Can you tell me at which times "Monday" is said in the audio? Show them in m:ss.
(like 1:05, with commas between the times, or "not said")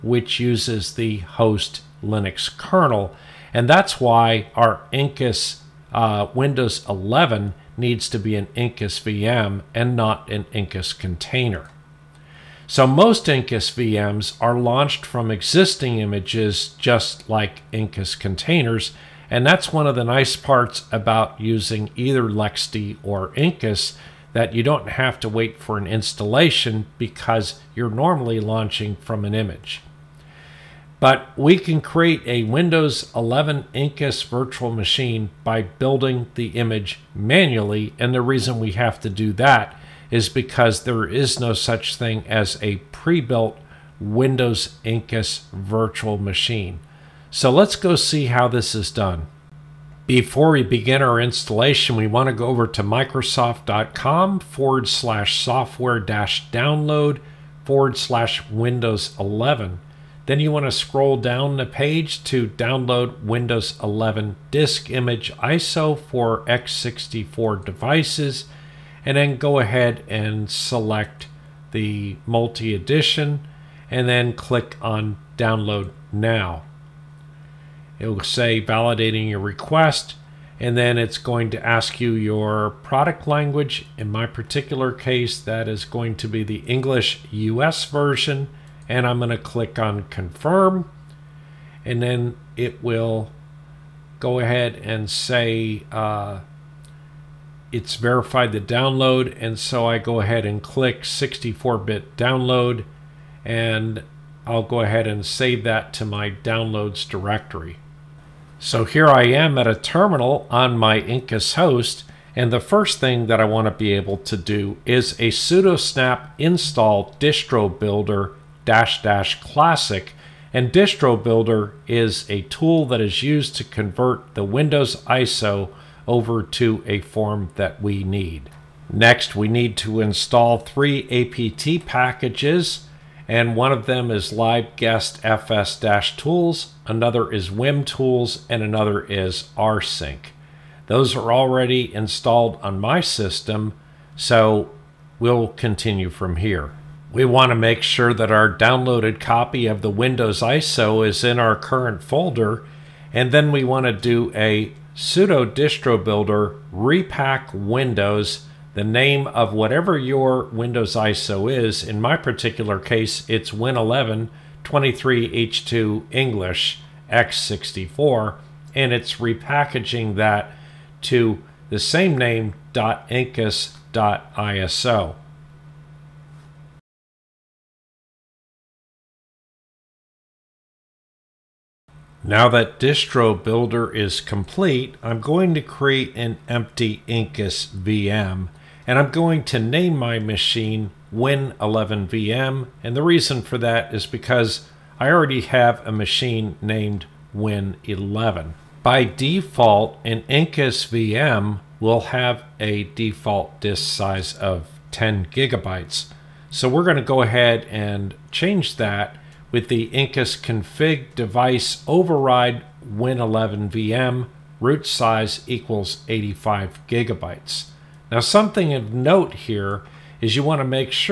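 not said.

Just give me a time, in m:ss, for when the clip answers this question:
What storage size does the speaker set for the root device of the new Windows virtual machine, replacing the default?
3:36.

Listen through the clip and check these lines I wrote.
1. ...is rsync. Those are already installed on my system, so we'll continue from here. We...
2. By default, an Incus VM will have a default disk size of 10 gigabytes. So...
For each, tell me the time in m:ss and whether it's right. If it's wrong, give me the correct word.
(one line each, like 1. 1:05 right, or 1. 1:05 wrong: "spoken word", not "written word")
1. 2:19 right
2. 3:18 right.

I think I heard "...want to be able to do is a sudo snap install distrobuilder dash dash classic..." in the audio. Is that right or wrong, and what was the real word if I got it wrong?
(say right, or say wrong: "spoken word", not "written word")
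right.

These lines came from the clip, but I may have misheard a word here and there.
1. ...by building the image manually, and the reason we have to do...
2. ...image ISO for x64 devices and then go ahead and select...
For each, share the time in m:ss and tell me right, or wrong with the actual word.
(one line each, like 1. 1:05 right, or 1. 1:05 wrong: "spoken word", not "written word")
1. 0:35 right
2. 1:04 right.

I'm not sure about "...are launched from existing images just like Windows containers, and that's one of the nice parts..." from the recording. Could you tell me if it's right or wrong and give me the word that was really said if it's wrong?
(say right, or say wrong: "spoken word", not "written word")
wrong: "Incus", not "Windows".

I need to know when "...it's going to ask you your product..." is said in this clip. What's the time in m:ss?
1:20.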